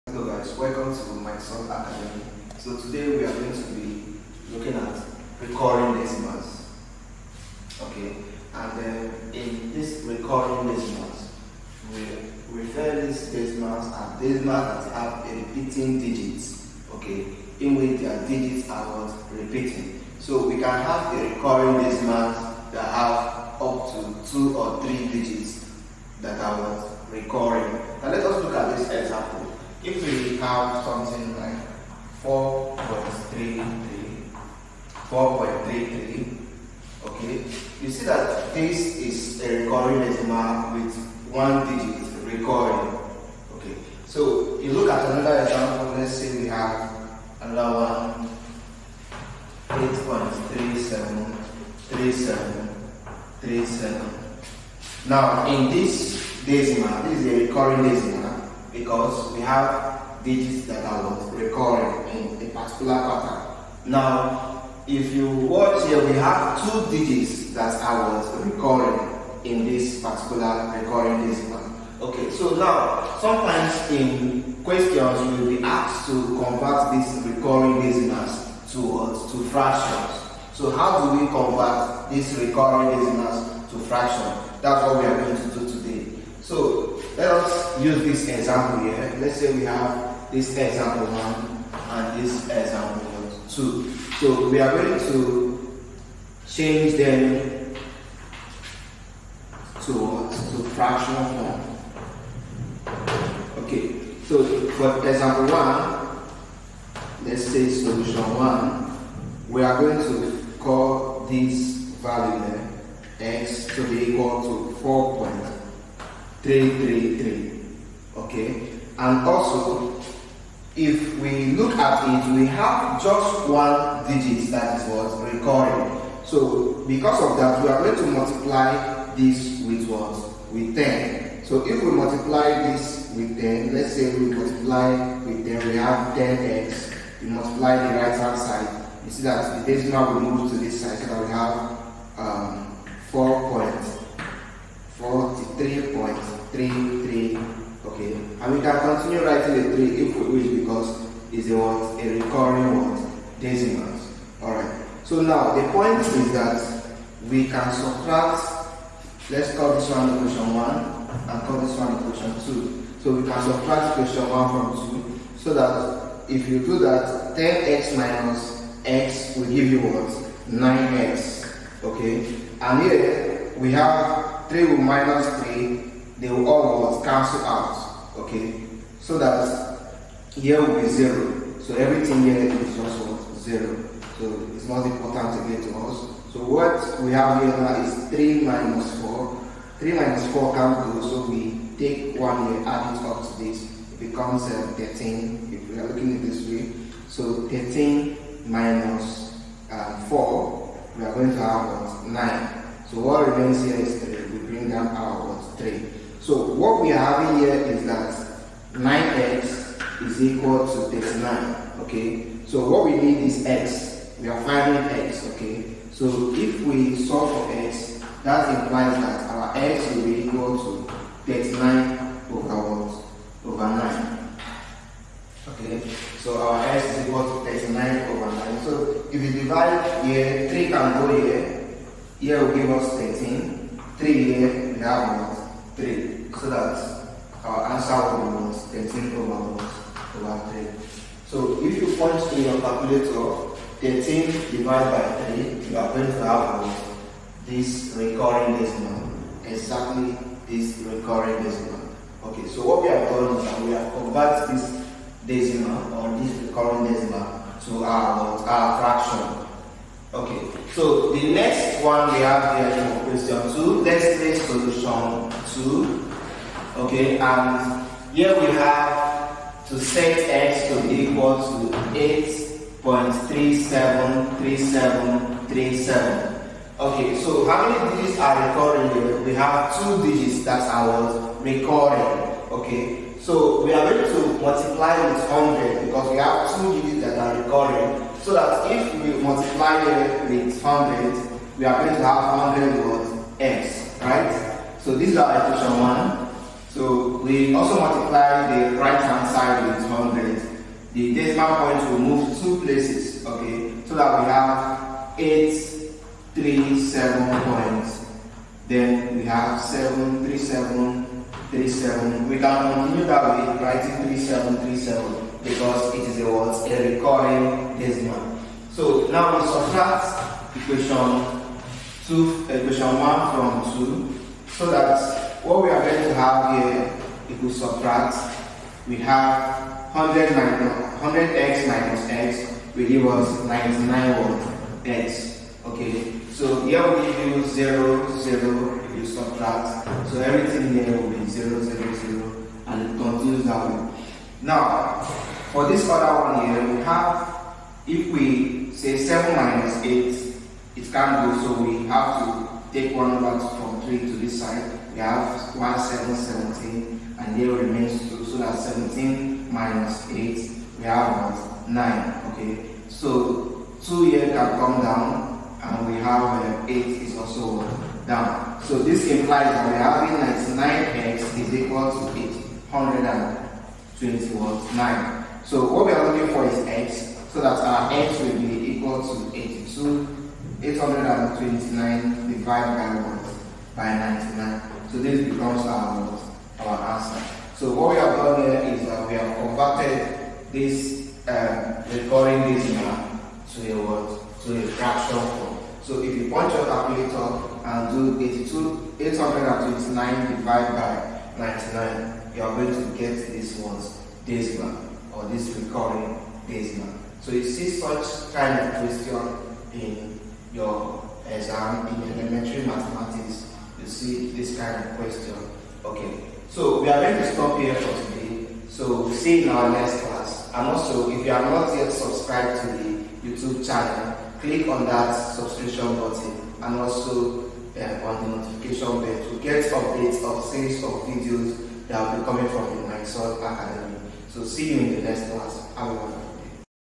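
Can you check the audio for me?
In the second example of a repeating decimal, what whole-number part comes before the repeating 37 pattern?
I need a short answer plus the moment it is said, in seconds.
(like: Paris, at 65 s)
8, at 49 s.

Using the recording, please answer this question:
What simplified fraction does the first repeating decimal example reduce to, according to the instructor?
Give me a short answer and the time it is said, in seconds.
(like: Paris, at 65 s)
13/3, at 243 s.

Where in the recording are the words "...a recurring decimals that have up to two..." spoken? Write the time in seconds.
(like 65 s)
21 s.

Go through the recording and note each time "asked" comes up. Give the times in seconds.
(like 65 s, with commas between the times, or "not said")
75 s.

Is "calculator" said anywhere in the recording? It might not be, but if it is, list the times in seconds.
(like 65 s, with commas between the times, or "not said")
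242 s, 396 s.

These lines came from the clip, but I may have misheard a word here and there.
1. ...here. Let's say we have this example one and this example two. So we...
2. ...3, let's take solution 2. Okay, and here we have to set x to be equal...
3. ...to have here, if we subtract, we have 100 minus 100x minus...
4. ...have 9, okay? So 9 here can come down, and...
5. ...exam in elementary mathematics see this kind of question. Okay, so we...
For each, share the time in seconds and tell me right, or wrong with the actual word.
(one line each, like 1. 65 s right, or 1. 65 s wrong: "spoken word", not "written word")
1. 88 s right
2. 263 s wrong: "2", not "3"
3. 326 s right
4. 360 s wrong: "2", not "9"
5. 411 s right.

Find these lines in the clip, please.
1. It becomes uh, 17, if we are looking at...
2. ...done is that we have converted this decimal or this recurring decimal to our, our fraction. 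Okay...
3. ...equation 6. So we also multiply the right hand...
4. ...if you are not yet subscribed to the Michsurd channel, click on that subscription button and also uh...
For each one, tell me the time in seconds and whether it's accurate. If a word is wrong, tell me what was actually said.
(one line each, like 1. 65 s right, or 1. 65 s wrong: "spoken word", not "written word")
1. 193 s wrong: "13", not "17"
2. 253 s right
3. 295 s wrong: "1", not "6"
4. 421 s wrong: "YouTube", not "Michsurd".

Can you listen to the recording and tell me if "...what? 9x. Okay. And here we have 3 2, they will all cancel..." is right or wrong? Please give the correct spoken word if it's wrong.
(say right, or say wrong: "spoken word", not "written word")
wrong: "3", not "2".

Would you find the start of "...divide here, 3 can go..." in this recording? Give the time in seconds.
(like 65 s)
229 s.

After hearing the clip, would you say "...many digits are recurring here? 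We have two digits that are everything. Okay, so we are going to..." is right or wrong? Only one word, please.
wrong.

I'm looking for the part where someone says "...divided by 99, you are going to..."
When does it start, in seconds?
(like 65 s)
400 s.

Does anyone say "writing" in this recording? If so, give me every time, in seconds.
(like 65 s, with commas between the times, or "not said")
149 s, 313 s.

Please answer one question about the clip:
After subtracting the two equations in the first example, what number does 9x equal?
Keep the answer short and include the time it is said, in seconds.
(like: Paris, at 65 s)
39, at 208 s.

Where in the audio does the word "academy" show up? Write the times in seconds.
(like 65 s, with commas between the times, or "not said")
1 s, 433 s.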